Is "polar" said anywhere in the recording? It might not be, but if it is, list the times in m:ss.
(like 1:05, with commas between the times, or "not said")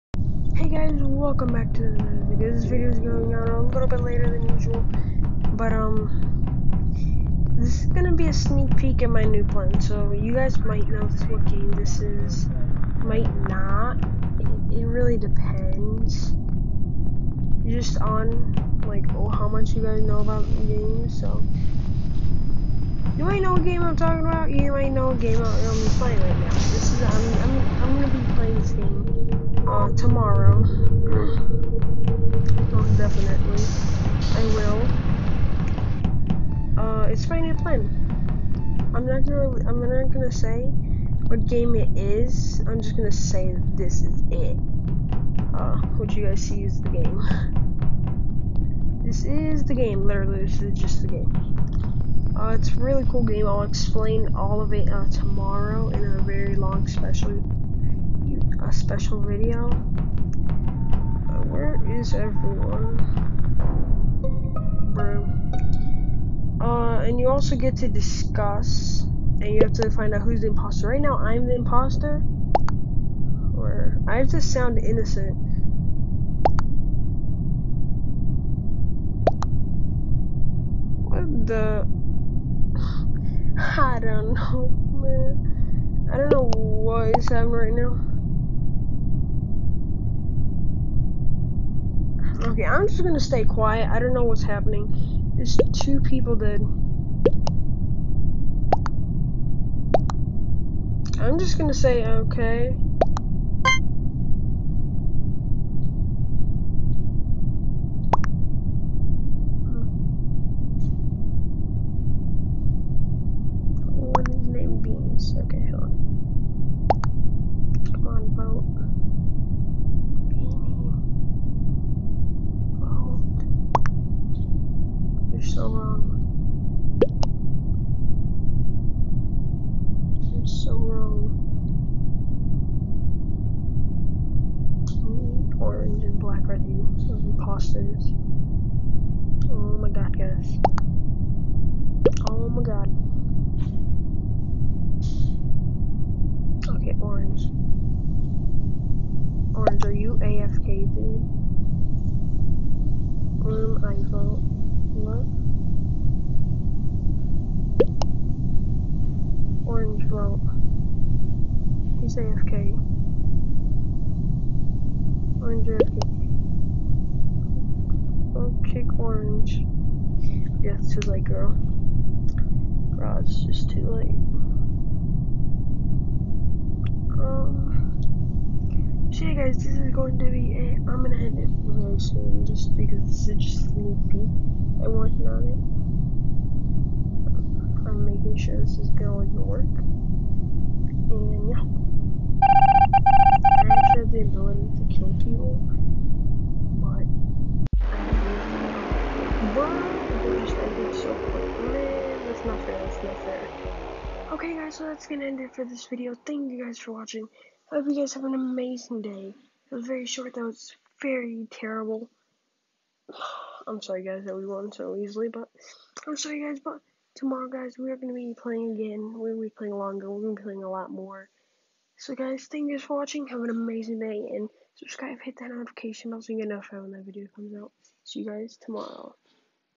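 not said.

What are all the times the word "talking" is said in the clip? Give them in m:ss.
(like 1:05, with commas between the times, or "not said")
0:23.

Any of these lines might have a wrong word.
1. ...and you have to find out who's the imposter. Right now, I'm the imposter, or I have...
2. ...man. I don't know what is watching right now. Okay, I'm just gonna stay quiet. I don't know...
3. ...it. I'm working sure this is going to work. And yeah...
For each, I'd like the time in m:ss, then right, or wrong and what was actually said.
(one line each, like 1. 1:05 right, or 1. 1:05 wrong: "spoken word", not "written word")
1. 1:09 right
2. 1:25 wrong: "happening", not "watching"
3. 3:07 wrong: "making", not "working".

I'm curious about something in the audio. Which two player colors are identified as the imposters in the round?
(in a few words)
Orange and black.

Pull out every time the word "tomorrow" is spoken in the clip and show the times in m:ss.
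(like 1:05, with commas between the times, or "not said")
0:55, 3:37, 3:48.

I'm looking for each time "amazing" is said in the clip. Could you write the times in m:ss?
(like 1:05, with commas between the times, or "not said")
3:28, 3:43.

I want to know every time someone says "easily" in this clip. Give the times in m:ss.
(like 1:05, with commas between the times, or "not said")
3:34.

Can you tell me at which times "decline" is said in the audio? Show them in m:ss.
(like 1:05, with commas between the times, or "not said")
not said.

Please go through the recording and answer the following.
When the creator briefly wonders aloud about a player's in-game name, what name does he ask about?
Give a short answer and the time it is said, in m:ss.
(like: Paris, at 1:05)
Beans, at 1:54.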